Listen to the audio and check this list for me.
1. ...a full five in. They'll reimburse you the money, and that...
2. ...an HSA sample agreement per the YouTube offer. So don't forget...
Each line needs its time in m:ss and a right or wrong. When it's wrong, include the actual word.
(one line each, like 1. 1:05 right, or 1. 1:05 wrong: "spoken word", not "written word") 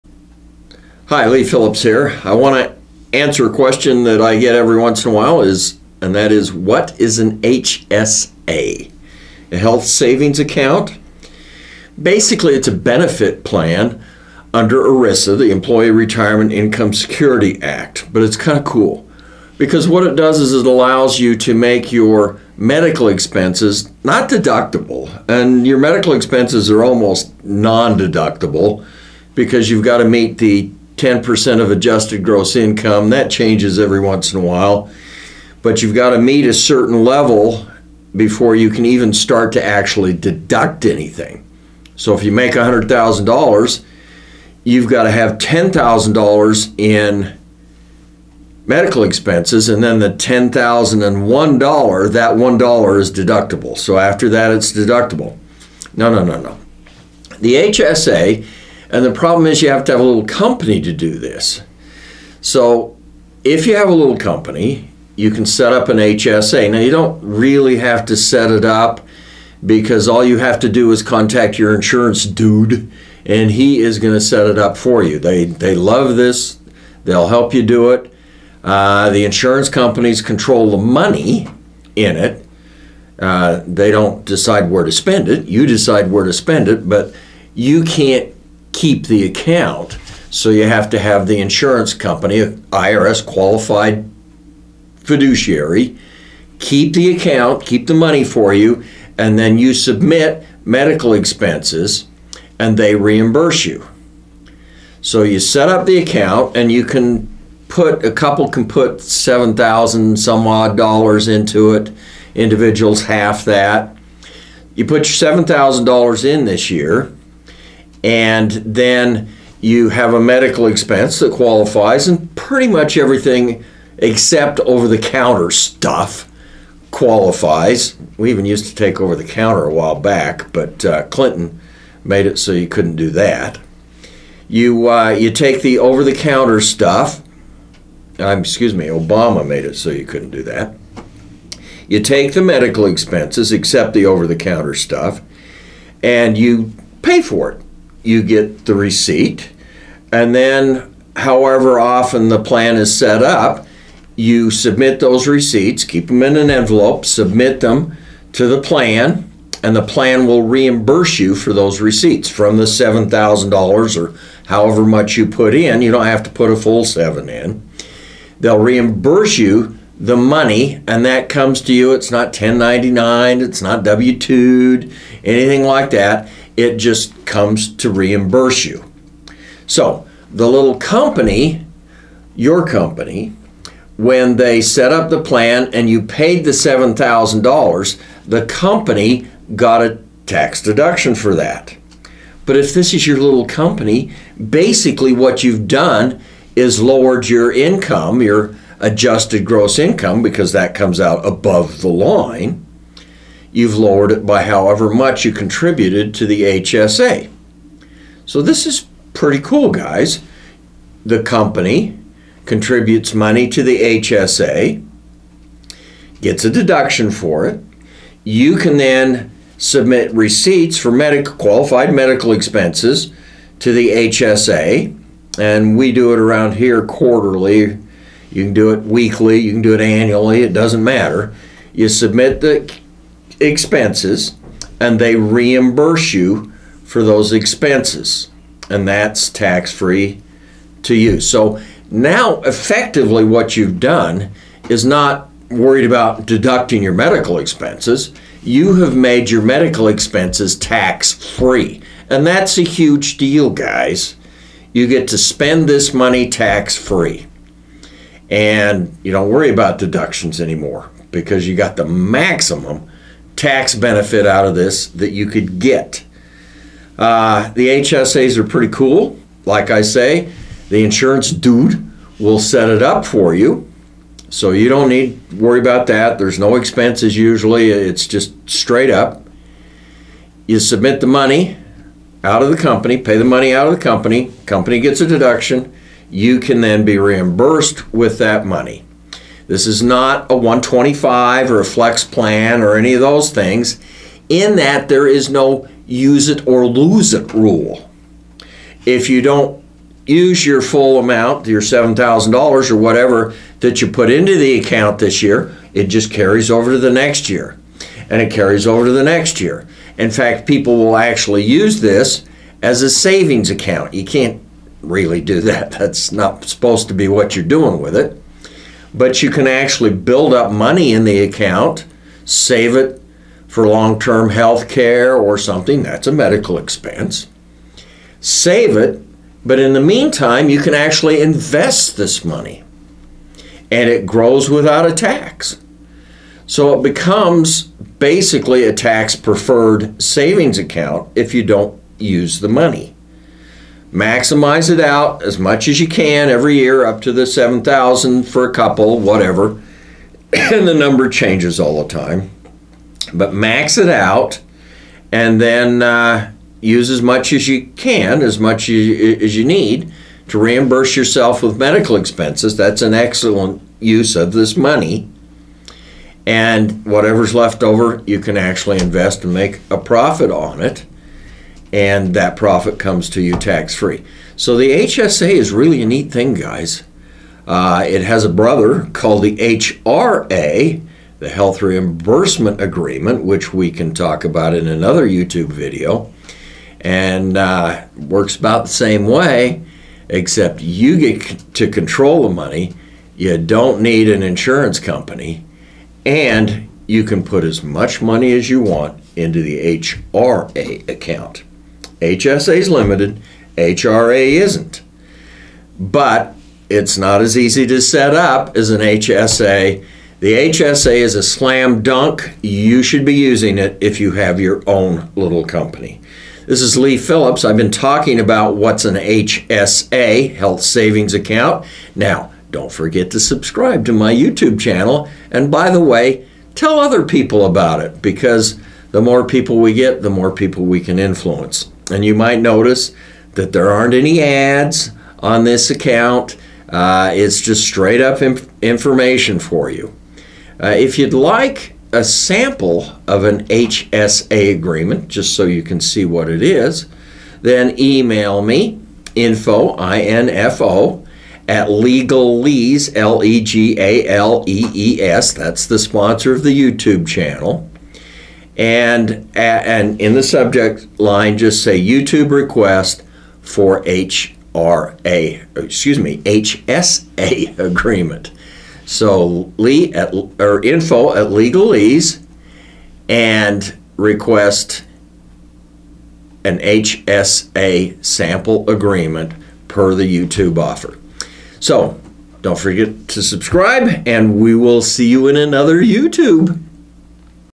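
1. 2:46 wrong: "seven", not "five"
2. 7:56 right.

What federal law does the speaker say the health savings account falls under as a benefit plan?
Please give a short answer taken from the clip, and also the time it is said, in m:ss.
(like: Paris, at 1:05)
Employee Retirement Income Security Act, at 0:15.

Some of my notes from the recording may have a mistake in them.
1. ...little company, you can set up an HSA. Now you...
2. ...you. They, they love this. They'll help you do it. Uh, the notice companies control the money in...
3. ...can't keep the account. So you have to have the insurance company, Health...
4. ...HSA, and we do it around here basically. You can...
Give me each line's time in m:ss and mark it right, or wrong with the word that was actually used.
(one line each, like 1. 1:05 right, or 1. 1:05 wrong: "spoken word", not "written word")
1. 1:03 right
2. 1:15 wrong: "insurance", not "notice"
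3. 1:27 wrong: "IRS", not "Health"
4. 3:43 wrong: "quarterly", not "basically".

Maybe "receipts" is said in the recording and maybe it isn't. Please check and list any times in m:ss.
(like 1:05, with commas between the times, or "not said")
2:28, 2:35, 2:41, 3:40.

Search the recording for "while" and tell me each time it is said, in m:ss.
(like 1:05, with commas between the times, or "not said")
0:05, 0:34, 2:09.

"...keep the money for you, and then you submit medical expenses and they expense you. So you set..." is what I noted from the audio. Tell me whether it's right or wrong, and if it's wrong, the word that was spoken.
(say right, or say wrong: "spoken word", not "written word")
wrong: "reimburse", not "expense".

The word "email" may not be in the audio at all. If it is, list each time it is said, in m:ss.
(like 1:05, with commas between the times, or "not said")
7:27.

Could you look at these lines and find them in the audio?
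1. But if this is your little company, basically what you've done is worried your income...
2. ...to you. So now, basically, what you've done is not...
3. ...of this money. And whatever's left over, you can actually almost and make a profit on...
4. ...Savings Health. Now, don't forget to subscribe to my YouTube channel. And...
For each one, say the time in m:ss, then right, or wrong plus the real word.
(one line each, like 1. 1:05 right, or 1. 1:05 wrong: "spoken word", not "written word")
1. 3:12 wrong: "lowered", not "worried"
2. 4:00 wrong: "effectively", not "basically"
3. 6:04 wrong: "invest", not "almost"
4. 7:00 wrong: "Account", not "Health".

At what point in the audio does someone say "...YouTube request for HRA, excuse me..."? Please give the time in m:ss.
7:41.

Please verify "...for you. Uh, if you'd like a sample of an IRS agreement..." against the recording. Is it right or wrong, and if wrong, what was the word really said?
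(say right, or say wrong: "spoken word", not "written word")
wrong: "HSA", not "IRS".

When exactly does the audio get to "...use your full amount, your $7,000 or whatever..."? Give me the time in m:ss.
5:00.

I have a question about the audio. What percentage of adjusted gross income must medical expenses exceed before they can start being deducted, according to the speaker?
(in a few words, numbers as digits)
10%.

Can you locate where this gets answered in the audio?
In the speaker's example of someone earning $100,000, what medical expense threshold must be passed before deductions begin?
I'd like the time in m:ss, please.
0:45.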